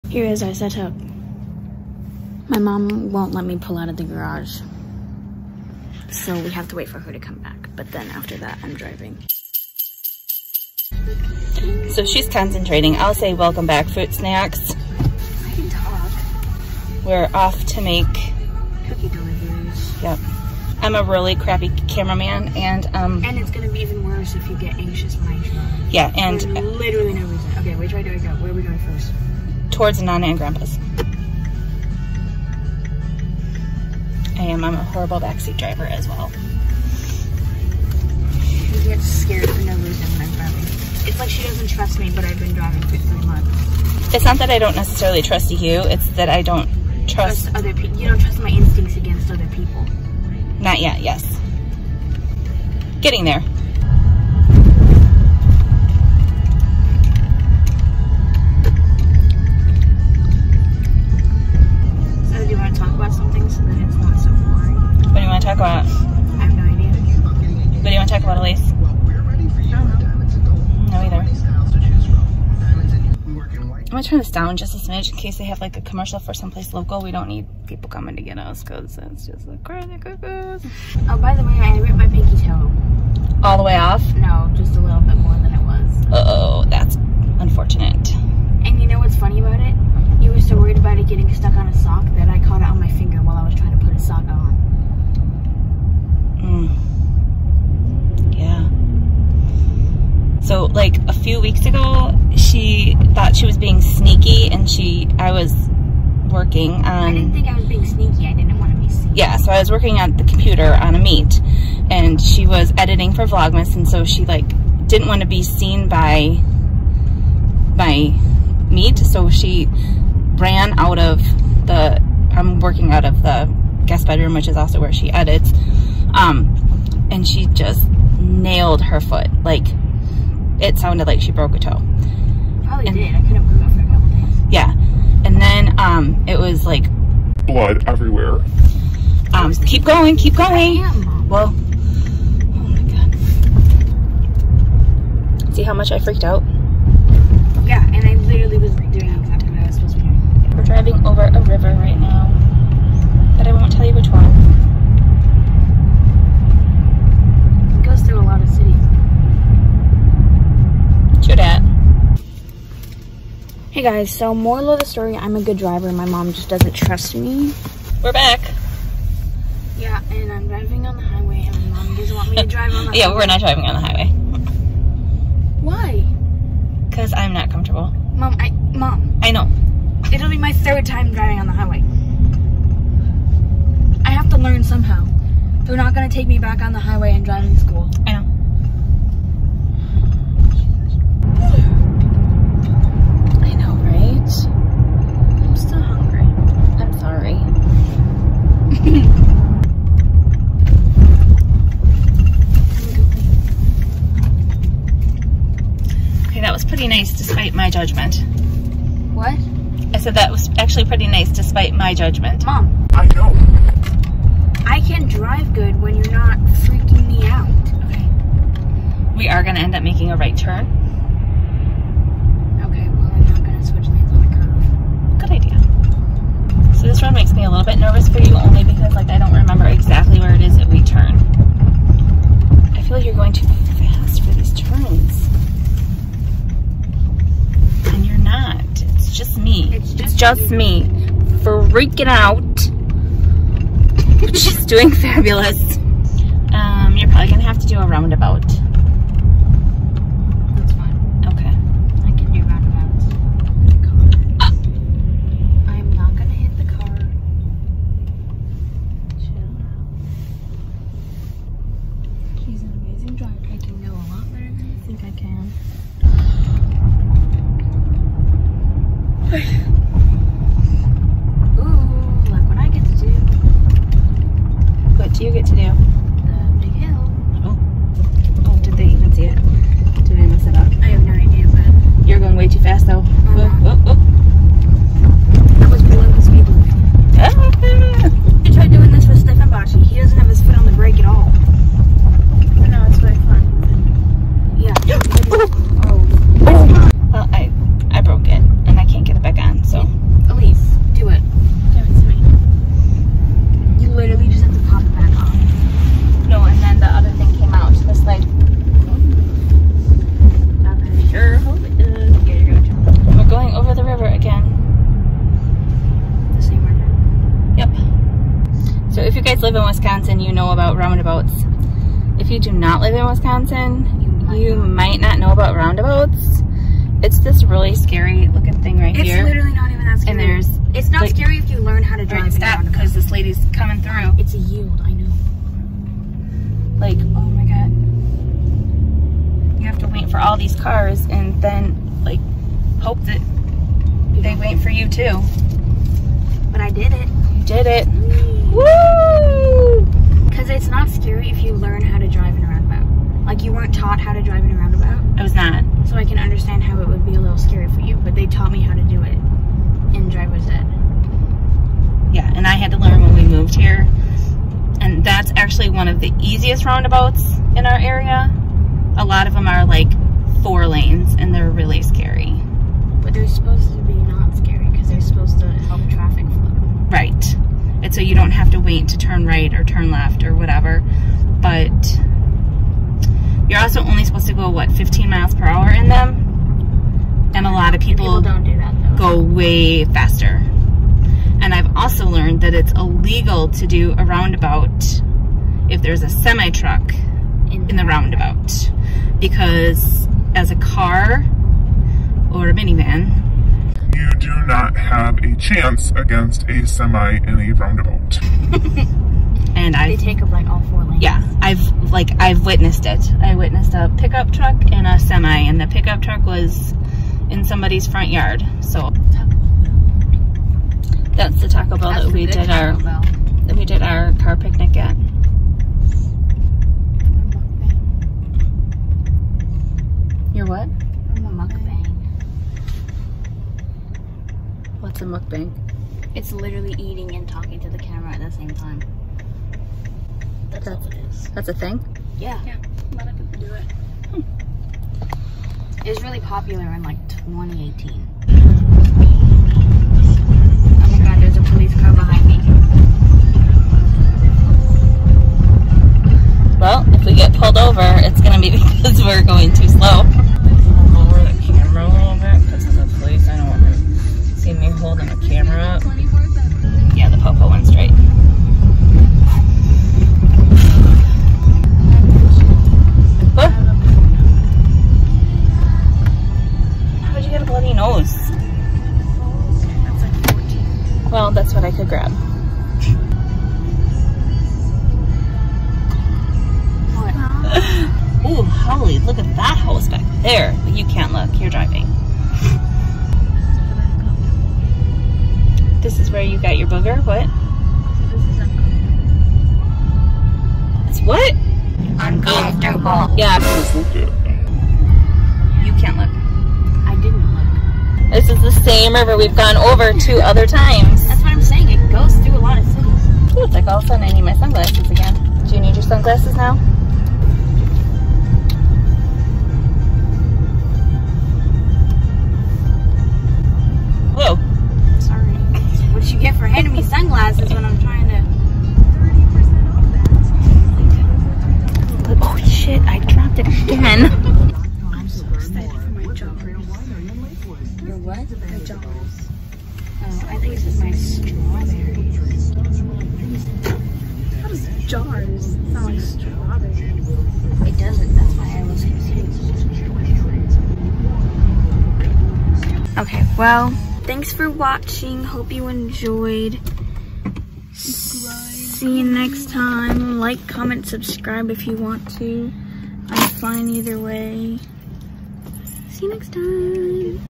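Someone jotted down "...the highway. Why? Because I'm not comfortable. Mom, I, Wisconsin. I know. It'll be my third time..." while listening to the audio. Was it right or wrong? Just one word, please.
wrong.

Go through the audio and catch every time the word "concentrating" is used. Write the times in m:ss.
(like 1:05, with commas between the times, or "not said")
0:12.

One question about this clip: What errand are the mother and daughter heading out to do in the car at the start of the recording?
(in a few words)
Cookie deliveries.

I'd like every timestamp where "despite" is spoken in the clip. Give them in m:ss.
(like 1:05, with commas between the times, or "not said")
3:27, 3:31.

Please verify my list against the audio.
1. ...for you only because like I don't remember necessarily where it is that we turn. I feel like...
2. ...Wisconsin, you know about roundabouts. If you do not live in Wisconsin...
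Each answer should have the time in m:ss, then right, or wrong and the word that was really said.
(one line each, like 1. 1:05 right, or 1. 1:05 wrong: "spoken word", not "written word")
1. 3:48 wrong: "exactly", not "necessarily"
2. 5:19 right.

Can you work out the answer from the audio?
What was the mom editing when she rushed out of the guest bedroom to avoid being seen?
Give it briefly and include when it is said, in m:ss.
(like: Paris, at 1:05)
Vlogmas, at 1:53.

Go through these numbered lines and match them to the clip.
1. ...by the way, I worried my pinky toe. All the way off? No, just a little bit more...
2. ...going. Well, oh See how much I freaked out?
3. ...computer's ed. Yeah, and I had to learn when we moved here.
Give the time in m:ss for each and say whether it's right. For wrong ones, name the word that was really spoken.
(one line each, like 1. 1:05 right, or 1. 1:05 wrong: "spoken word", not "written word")
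1. 1:21 wrong: "ripped", not "worried"
2. 2:20 right
3. 6:00 wrong: "driver", not "computer".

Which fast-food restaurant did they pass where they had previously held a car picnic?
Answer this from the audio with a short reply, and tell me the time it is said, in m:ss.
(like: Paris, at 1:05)
Taco Bell, at 7:01.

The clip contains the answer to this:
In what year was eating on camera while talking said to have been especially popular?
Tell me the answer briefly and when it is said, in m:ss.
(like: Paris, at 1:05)
2018, at 7:27.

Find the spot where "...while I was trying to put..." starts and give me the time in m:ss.
1:33.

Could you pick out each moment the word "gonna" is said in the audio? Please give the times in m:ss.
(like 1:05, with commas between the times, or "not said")
1:14, 4:07, 7:38.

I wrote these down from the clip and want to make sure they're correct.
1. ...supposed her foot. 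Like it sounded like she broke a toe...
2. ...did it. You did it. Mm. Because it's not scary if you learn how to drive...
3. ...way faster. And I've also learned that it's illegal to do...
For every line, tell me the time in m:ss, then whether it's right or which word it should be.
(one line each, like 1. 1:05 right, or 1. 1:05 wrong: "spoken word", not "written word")
1. 2:08 wrong: "nailed", not "supposed"
2. 5:46 right
3. 6:29 right.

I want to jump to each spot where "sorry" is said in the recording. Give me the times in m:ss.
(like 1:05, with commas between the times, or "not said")
3:16, 8:44.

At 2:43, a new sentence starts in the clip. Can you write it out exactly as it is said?
guys, so moral of the story, I'm a good driver.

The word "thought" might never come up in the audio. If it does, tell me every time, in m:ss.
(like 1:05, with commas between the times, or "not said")
1:43.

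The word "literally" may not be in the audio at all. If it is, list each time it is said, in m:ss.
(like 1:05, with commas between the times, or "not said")
0:26, 2:28, 5:29, 7:16.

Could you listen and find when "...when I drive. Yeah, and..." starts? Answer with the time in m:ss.
0:25.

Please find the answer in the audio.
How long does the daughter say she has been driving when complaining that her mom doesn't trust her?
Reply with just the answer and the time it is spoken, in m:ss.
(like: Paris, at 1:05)
3 months, at 0:42.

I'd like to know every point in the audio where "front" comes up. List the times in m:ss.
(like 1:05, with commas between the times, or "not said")
6:57.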